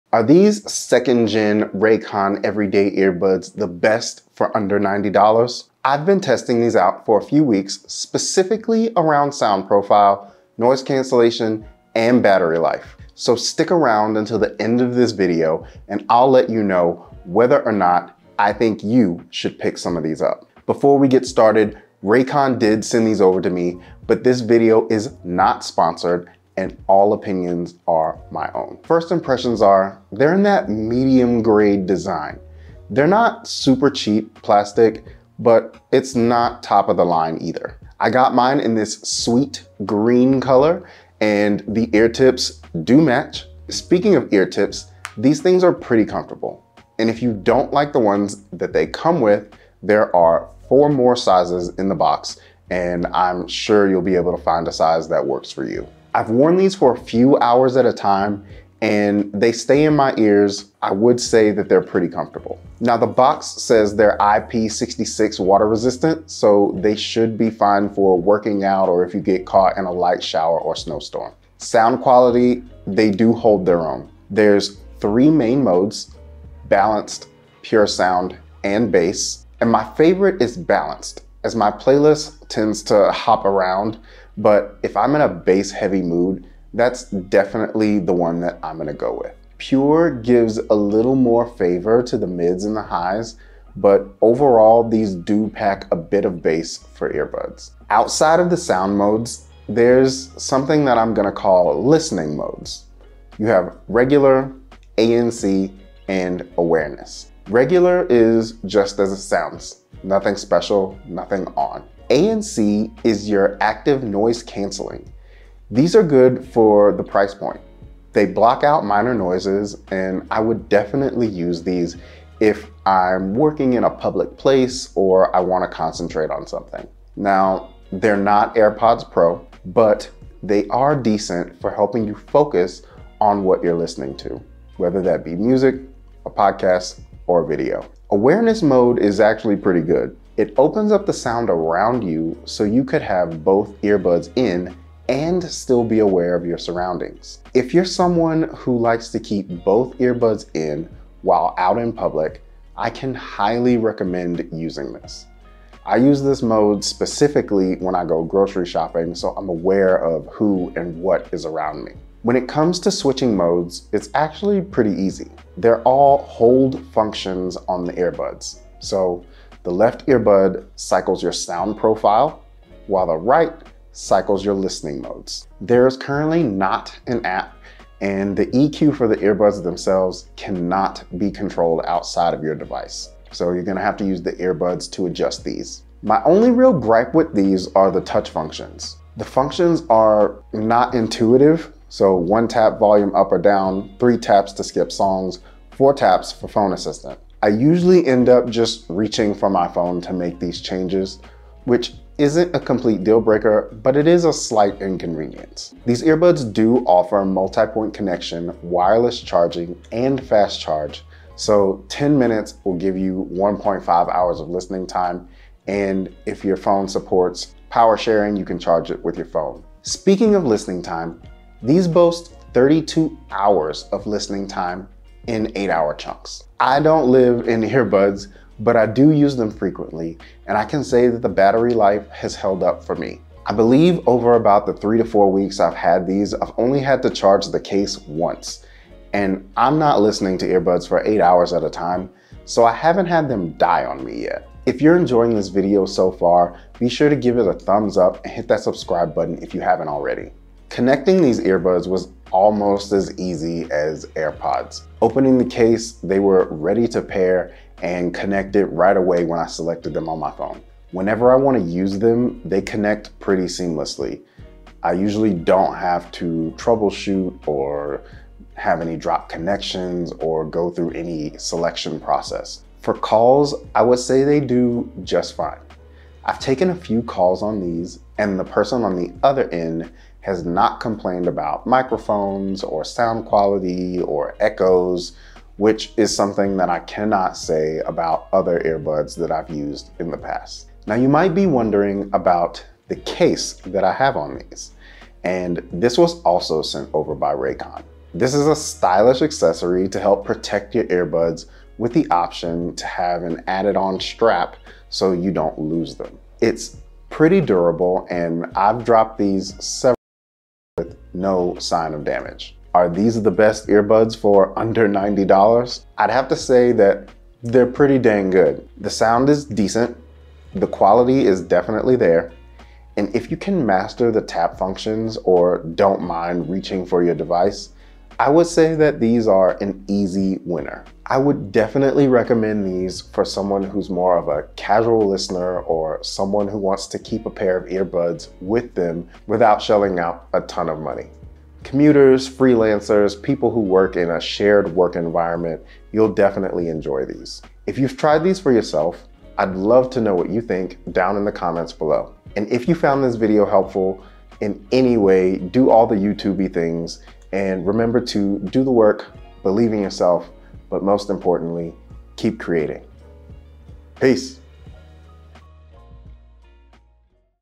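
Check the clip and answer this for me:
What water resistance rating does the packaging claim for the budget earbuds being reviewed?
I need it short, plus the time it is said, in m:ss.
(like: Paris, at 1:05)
IP66, at 1:04.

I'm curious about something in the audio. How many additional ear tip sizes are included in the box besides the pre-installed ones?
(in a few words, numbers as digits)
4.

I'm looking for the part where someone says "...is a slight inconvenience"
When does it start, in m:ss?
3:24.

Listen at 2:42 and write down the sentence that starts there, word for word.
When it comes to switching modes, it's actually pretty easy.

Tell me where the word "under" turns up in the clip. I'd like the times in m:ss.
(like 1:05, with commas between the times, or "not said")
0:04, 5:14.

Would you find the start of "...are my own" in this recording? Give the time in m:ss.
0:27.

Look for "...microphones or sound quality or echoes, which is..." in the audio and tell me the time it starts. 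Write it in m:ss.
4:41.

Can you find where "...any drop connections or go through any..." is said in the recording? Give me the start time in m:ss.
4:28.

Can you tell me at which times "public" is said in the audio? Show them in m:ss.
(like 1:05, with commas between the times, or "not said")
2:03, 2:31.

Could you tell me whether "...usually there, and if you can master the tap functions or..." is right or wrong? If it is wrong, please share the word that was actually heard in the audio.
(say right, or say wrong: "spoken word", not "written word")
wrong: "definitely", not "usually".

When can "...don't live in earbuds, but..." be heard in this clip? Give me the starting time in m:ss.
3:46.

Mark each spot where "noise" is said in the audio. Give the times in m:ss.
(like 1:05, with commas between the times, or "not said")
0:10, 1:54, 1:59.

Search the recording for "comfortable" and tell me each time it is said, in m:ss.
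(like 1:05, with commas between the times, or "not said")
0:46, 1:02.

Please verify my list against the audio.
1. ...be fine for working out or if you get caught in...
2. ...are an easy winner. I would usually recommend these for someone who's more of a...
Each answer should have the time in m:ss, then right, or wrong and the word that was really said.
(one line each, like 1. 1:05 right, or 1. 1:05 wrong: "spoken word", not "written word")
1. 1:07 right
2. 5:29 wrong: "definitely", not "usually".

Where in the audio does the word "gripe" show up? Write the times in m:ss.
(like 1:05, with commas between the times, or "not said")
3:06.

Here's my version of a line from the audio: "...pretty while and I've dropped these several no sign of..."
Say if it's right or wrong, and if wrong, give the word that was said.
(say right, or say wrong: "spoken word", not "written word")
wrong: "durable", not "while".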